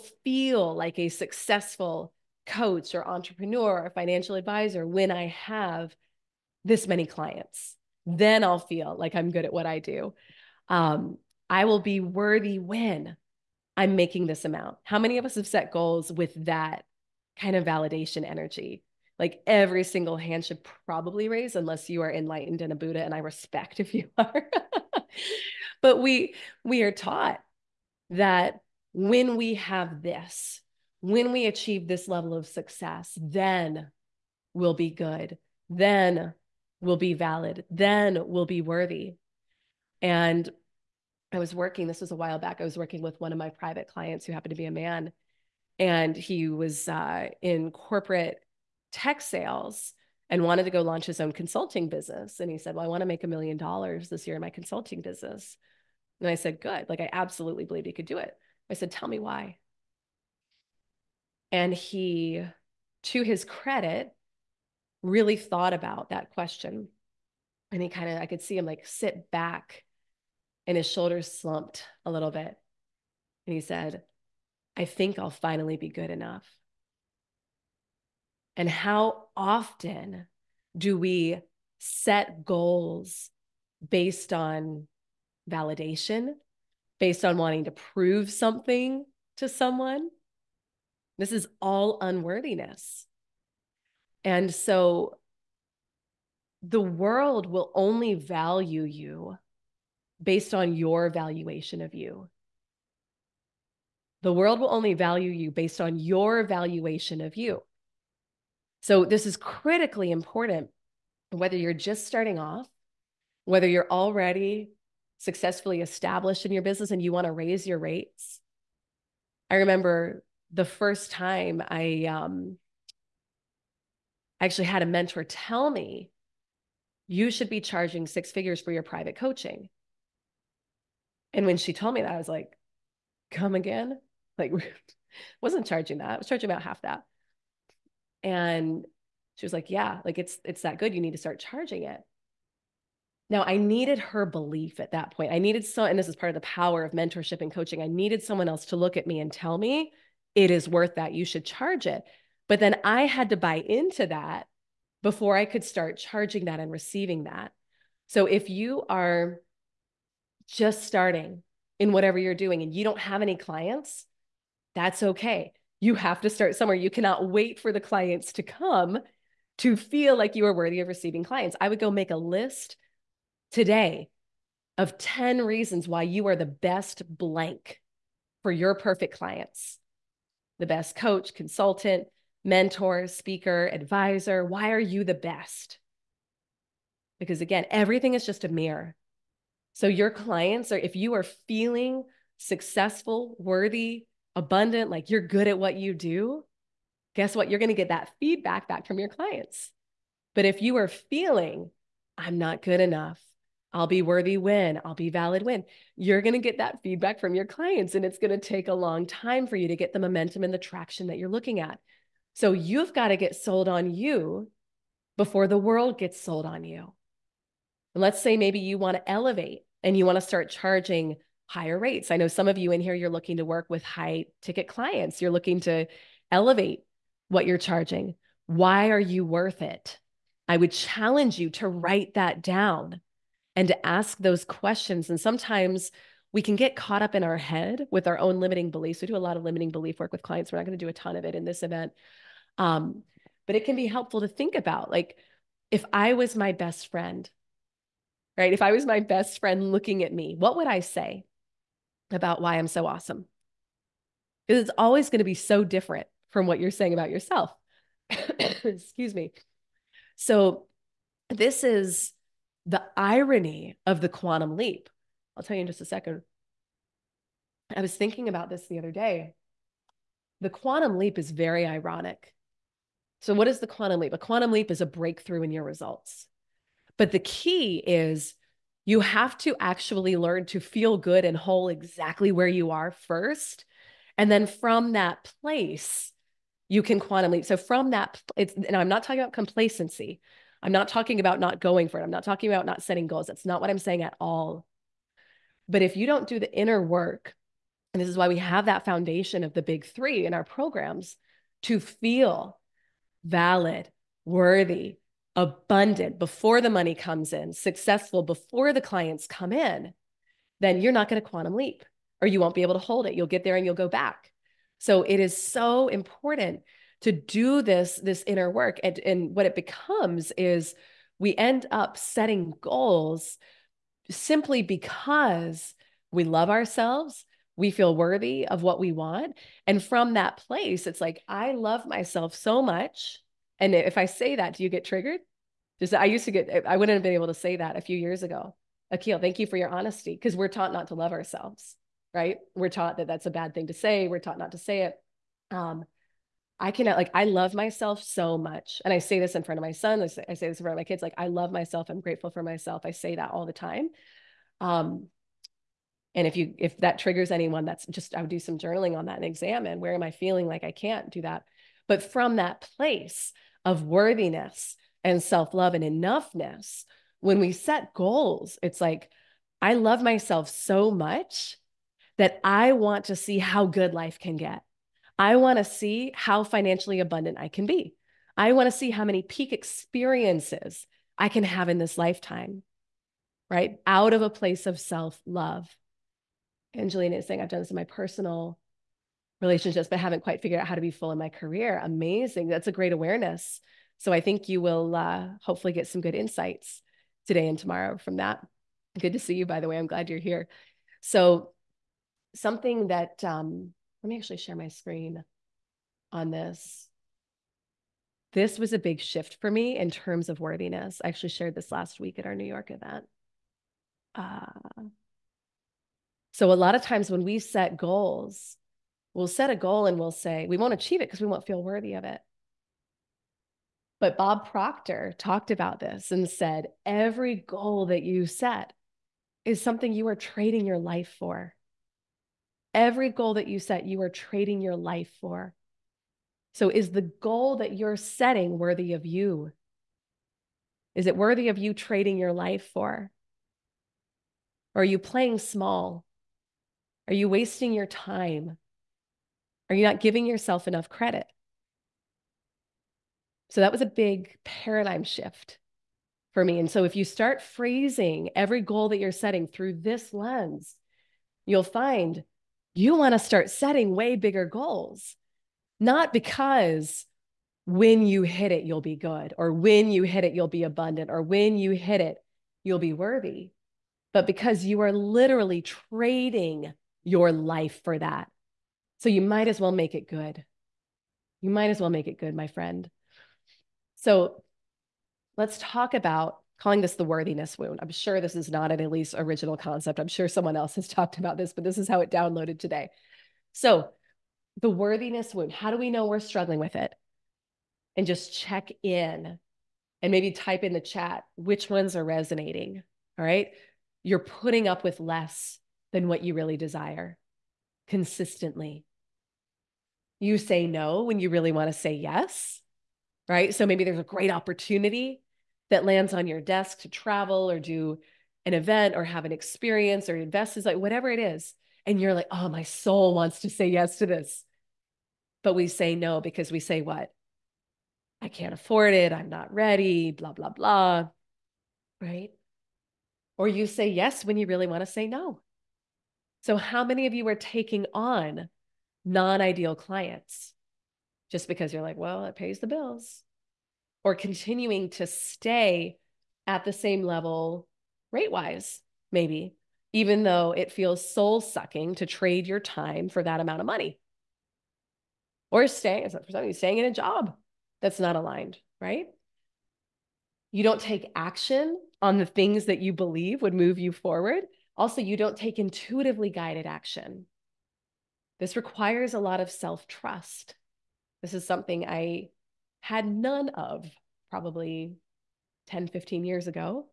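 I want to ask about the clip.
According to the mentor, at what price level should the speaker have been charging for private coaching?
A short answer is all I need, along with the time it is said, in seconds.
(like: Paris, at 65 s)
six figures, at 128 s.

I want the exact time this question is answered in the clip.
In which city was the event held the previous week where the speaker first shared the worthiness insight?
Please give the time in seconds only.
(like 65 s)
412 s.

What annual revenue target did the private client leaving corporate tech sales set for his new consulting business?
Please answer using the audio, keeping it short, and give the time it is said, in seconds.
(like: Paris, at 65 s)
a million dollars, at 53 s.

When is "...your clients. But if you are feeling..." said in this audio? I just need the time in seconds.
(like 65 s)
198 s.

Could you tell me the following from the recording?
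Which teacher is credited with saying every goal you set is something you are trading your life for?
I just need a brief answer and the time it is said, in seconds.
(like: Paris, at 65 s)
Bob Proctor, at 424 s.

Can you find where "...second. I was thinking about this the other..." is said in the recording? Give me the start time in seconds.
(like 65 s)
265 s.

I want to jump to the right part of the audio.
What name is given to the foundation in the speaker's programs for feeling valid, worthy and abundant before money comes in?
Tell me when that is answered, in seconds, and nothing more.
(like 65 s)
299 s.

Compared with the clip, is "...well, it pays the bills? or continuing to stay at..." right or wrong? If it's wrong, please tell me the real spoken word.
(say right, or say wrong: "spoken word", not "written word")
right.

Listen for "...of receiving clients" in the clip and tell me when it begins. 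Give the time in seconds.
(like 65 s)
170 s.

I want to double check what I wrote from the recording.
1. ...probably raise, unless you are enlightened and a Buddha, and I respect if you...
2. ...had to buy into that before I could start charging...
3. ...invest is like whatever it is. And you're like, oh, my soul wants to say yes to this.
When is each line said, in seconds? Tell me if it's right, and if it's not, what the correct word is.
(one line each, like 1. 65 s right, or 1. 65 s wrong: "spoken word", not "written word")
1. 20 s right
2. 153 s right
3. 520 s right.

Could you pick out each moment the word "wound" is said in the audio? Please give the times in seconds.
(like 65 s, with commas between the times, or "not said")
487 s, 495 s.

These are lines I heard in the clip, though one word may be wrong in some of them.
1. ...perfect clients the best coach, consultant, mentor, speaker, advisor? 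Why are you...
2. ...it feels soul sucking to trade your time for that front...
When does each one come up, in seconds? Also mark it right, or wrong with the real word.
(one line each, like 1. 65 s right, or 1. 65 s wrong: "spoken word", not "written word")
1. 178 s right
2. 550 s wrong: "amount", not "front".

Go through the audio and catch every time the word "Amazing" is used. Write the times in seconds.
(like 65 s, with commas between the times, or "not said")
391 s.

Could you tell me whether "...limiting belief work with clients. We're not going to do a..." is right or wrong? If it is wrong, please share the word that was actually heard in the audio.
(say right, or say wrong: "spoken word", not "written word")
right.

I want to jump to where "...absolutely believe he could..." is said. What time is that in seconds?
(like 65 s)
57 s.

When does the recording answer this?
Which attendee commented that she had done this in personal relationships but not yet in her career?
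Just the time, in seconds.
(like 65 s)
386 s.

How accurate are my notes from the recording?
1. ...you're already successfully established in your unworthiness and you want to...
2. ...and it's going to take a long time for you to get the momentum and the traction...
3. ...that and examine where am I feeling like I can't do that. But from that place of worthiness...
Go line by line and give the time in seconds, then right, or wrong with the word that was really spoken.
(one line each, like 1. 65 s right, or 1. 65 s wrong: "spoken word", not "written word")
1. 113 s wrong: "business", not "unworthiness"
2. 207 s right
3. 359 s right.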